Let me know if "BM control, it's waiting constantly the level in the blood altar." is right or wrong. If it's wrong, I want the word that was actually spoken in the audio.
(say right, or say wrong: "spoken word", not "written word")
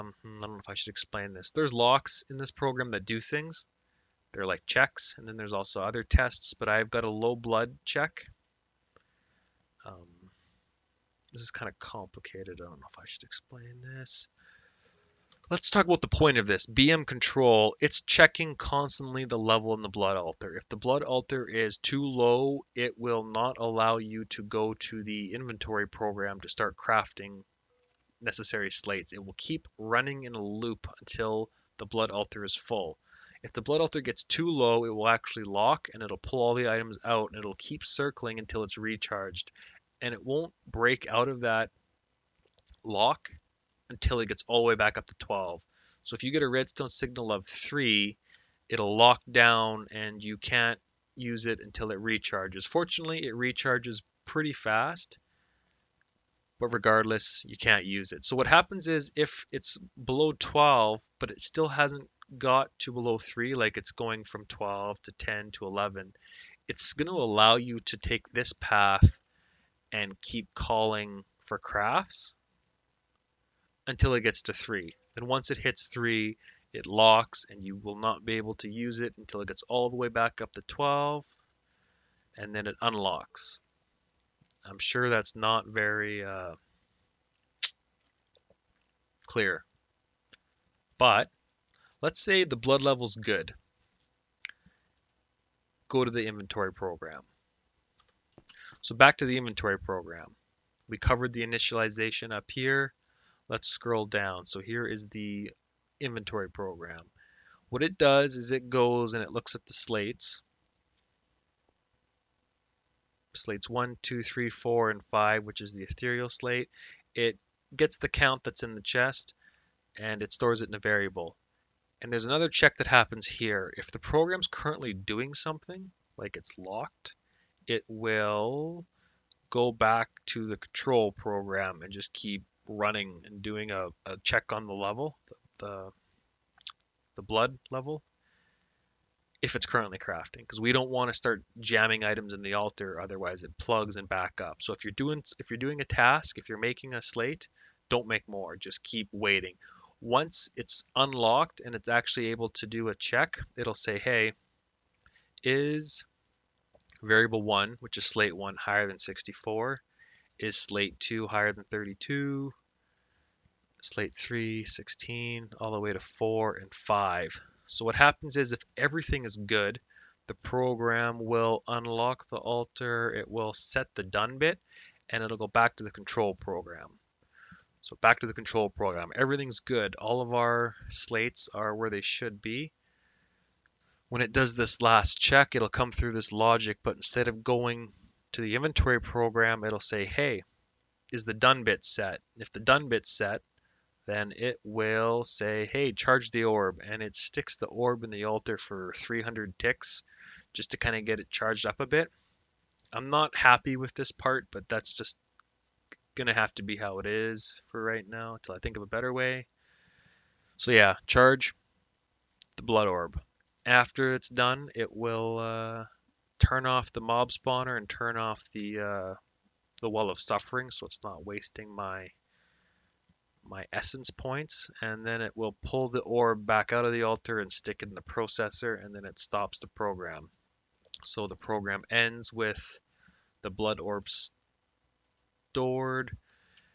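wrong: "checking", not "waiting".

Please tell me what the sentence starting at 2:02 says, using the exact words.
And there's another check that happens here.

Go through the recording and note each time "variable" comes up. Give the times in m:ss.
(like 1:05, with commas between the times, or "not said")
2:00, 2:37.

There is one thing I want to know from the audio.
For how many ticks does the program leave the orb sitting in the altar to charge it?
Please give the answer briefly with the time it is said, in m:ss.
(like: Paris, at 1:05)
300, at 3:18.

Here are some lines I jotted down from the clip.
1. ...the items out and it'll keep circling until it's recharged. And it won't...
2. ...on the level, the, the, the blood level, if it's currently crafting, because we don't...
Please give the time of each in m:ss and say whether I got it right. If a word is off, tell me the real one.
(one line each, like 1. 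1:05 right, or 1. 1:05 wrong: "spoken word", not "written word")
1. 0:36 right
2. 2:14 right.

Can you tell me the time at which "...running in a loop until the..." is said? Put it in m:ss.
0:29.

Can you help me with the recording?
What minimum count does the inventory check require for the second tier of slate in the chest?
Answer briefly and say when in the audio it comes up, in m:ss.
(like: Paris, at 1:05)
32, at 2:41.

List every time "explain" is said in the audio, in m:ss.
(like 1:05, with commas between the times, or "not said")
0:00, 0:13.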